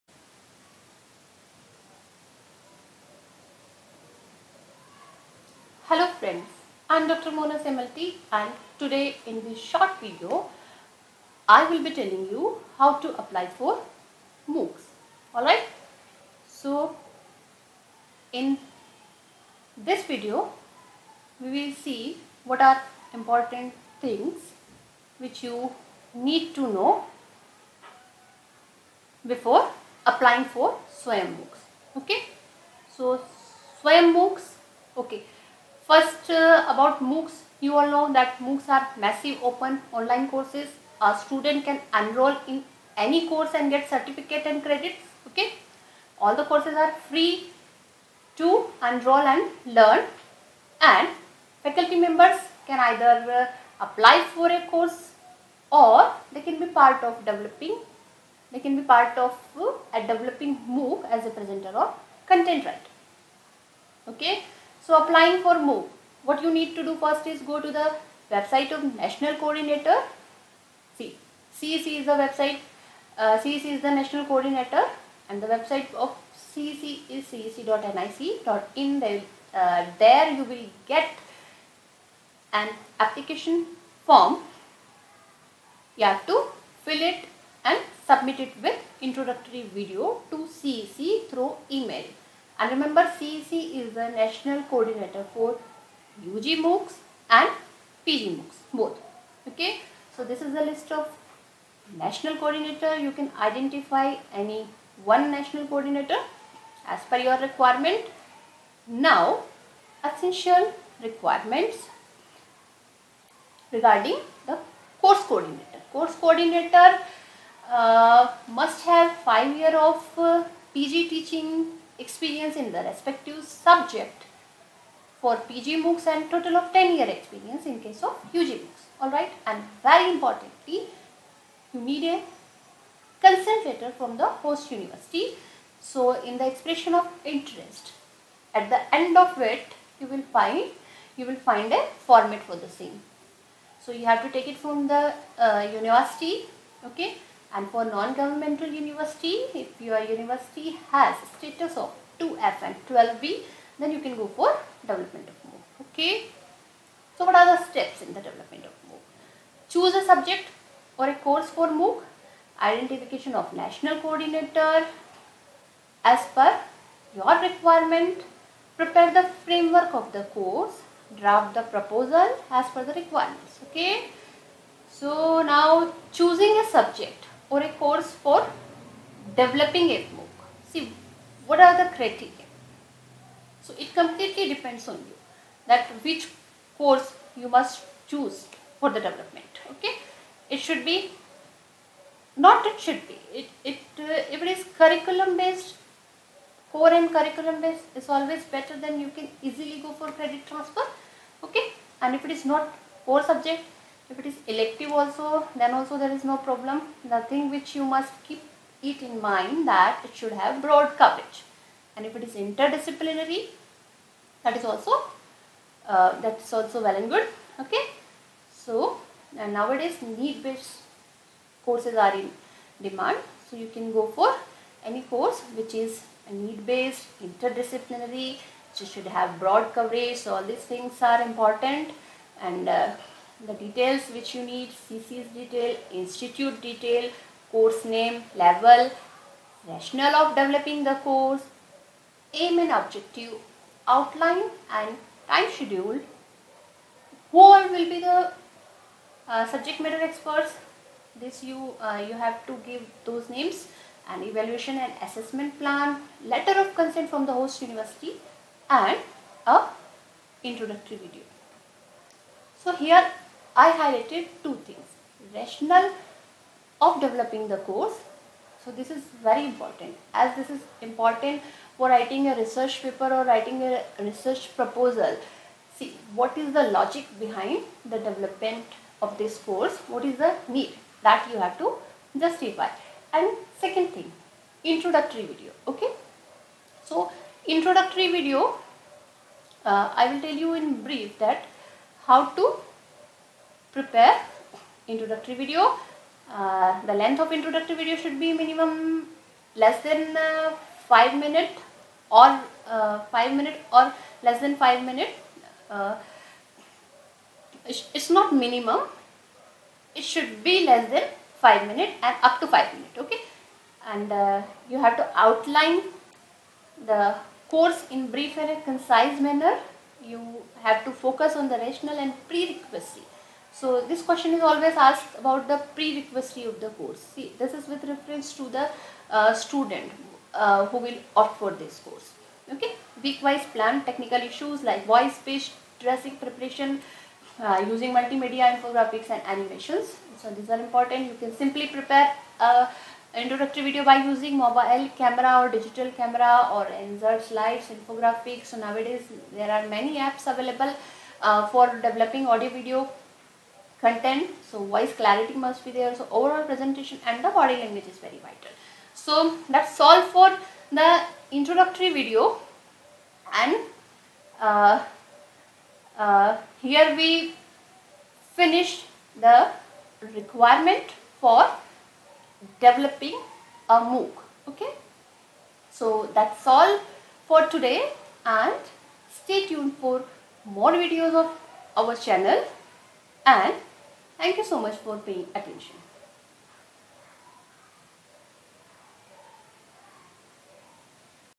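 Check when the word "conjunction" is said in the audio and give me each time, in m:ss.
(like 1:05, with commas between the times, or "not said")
not said.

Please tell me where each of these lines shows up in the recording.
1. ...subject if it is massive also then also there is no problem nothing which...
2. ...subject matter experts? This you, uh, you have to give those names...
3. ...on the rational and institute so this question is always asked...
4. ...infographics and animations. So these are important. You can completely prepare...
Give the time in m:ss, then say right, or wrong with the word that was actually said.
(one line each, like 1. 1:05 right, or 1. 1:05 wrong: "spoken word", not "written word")
1. 3:23 wrong: "elective", not "massive"
2. 4:09 right
3. 5:21 wrong: "prerequisite", not "institute"
4. 5:38 wrong: "simply", not "completely".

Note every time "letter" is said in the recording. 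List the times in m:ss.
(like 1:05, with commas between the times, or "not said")
2:13, 4:16.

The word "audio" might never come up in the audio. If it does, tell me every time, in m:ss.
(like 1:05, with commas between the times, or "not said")
5:52.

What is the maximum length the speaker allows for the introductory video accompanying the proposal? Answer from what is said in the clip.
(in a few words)
5 minutes.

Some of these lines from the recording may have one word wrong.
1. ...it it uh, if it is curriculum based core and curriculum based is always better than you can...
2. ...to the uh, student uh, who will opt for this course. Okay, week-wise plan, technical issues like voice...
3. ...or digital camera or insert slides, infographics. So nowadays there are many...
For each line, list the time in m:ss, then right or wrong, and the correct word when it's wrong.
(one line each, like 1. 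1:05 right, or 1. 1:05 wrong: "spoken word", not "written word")
1. 3:13 right
2. 5:28 right
3. 5:45 right.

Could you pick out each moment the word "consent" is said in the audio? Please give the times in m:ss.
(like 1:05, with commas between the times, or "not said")
2:13, 4:16.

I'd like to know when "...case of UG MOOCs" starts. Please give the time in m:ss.
2:07.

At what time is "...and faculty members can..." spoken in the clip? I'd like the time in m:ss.
0:50.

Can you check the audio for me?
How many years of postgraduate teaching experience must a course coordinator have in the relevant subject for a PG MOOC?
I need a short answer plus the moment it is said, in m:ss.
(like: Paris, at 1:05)
5, at 1:59.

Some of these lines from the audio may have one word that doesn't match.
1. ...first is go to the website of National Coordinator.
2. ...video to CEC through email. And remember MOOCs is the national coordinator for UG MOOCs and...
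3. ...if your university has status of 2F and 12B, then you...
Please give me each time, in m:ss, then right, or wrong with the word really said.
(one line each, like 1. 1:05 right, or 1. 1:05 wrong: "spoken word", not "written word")
1. 1:06 right
2. 1:29 wrong: "CEC", not "MOOCs"
3. 2:29 right.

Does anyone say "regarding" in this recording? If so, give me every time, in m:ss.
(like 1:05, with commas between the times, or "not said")
1:53.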